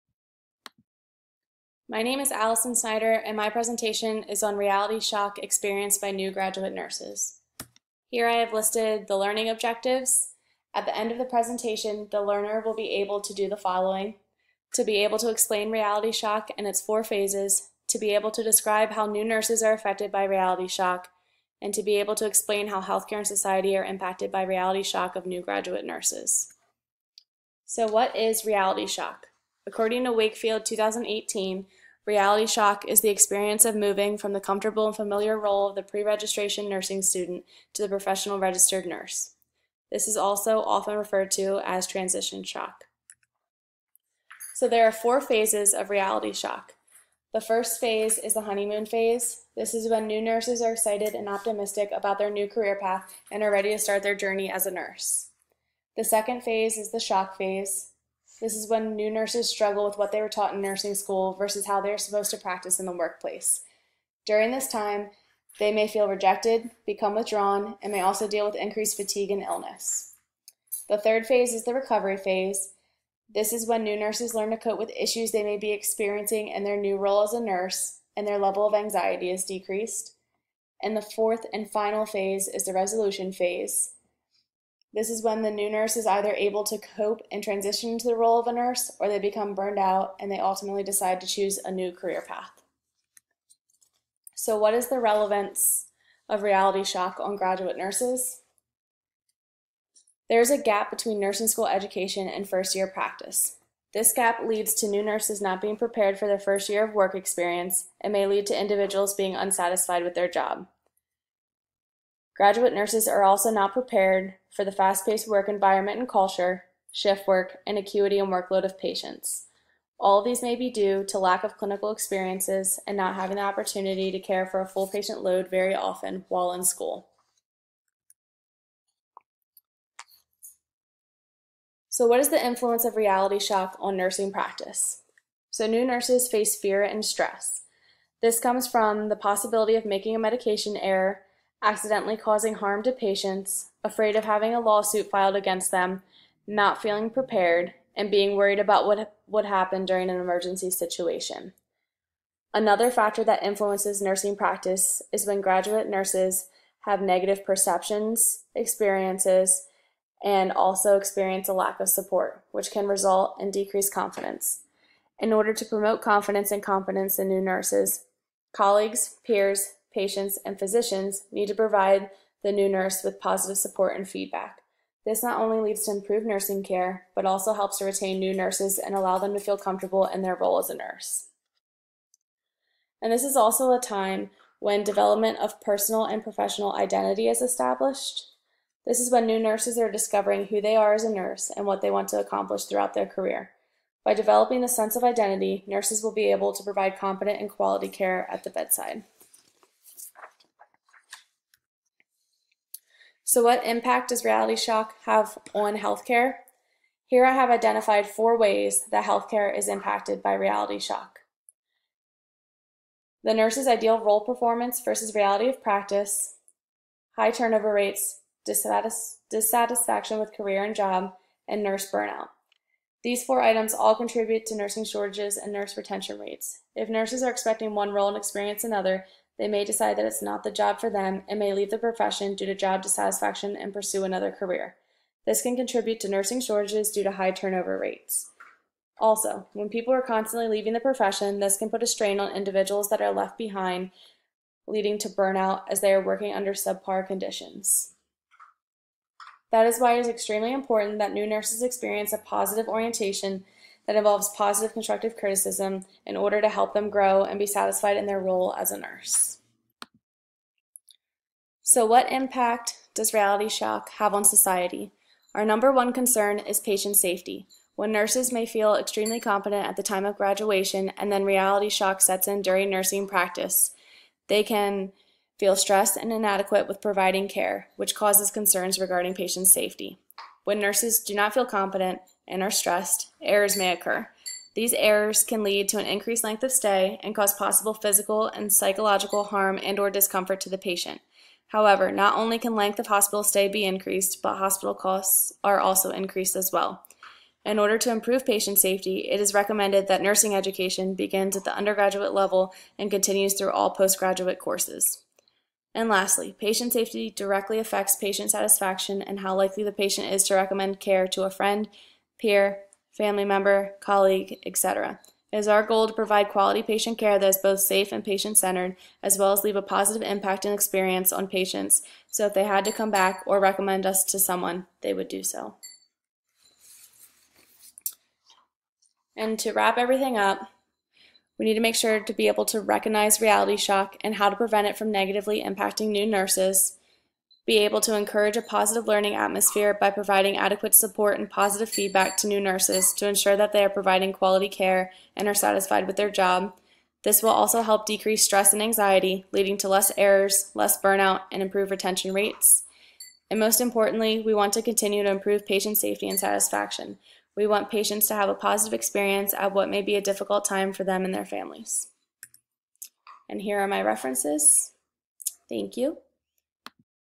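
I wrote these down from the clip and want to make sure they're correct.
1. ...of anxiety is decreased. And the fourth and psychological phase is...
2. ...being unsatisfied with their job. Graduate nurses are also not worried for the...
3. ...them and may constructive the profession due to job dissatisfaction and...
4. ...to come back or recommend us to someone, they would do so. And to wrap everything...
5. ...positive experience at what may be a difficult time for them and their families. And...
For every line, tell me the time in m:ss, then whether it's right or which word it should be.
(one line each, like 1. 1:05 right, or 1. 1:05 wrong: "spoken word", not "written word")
1. 1:18 wrong: "final", not "psychological"
2. 1:49 wrong: "prepared", not "worried"
3. 3:50 wrong: "leave", not "constructive"
4. 5:22 right
5. 5:58 right.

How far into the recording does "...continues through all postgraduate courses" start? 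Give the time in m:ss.
5:02.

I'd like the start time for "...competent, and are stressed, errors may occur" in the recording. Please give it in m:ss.
4:41.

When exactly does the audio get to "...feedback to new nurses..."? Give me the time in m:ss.
5:41.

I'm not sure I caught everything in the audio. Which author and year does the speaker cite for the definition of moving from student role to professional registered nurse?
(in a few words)
Wakefield 2018.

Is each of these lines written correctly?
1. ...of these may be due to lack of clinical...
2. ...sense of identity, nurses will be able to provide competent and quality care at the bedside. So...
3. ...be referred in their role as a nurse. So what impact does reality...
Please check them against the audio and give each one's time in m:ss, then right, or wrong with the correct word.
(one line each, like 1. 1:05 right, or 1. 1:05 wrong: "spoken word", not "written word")
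1. 2:00 right
2. 3:14 right
3. 4:17 wrong: "satisfied", not "referred".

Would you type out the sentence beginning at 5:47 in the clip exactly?
This will also help decrease stress and anxiety, leading to less errors, less burnout, and improved retention rates.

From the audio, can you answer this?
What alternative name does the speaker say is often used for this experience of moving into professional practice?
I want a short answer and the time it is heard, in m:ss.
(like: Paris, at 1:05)
transition shock, at 0:41.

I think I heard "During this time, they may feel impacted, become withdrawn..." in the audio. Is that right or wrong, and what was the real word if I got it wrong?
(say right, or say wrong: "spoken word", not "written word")
wrong: "rejected", not "impacted".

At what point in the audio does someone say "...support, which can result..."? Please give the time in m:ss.
2:41.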